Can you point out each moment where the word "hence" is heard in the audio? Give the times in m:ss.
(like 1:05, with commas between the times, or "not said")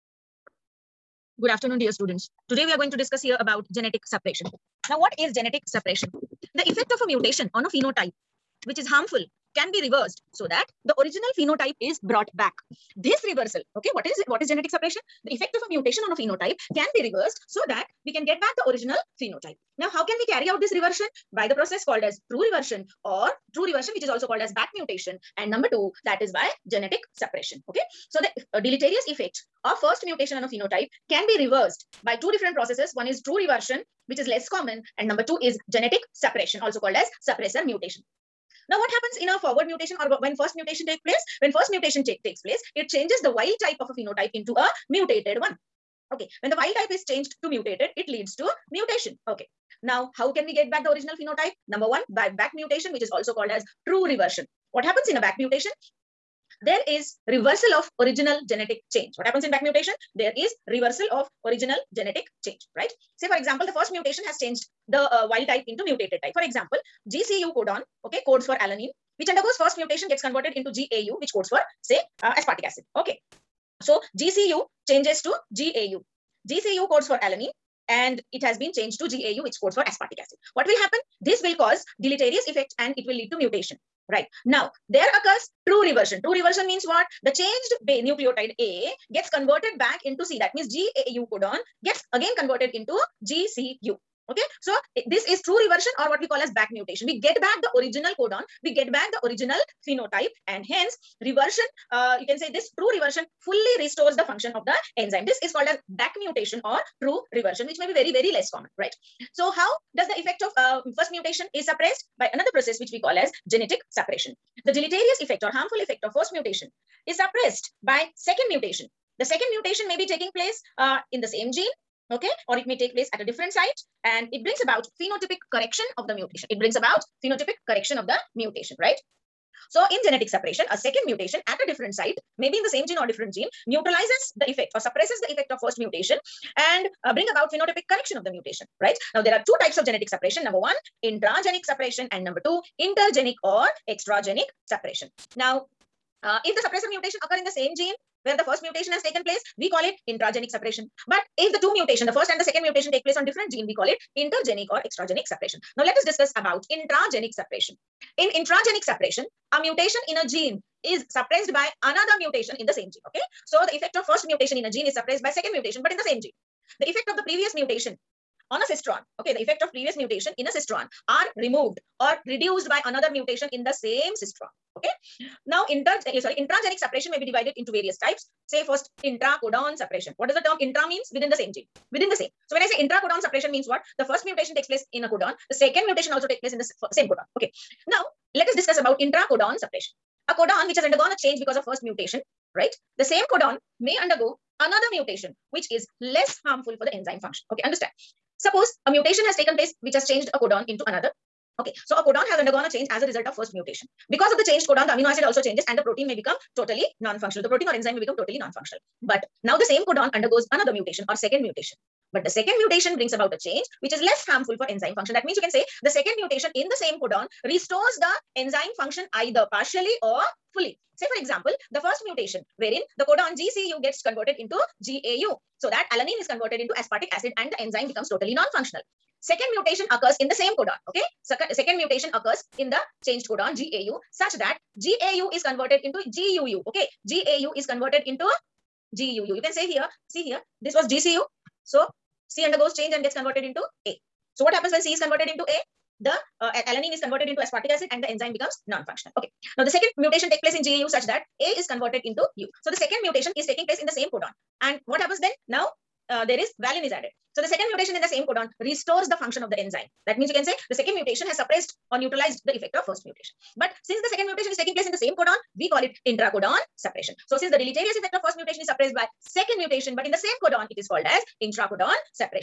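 1:40.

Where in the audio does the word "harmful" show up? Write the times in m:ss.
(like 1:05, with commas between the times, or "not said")
0:08, 1:55, 3:16, 3:34.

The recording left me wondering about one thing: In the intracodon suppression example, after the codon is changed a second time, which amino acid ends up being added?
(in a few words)
valine.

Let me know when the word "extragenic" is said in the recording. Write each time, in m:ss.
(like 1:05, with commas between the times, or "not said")
2:23, 2:34.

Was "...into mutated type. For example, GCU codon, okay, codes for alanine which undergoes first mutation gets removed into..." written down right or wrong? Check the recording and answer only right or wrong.
wrong.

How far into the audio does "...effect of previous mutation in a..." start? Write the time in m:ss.
2:49.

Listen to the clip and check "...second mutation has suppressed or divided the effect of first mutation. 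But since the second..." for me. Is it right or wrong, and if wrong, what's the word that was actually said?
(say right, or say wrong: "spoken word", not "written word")
wrong: "neutralized", not "divided".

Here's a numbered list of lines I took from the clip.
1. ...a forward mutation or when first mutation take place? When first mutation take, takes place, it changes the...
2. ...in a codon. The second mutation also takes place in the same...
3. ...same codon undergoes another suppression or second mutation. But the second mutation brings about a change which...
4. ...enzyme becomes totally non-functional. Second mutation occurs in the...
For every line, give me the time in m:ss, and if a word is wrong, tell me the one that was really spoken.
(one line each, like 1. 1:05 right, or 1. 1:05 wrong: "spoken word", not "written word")
1. 0:39 right
2. 3:04 right
3. 3:29 wrong: "mutation", not "suppression"
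4. 3:47 right.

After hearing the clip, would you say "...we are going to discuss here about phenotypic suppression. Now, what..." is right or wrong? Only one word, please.
wrong.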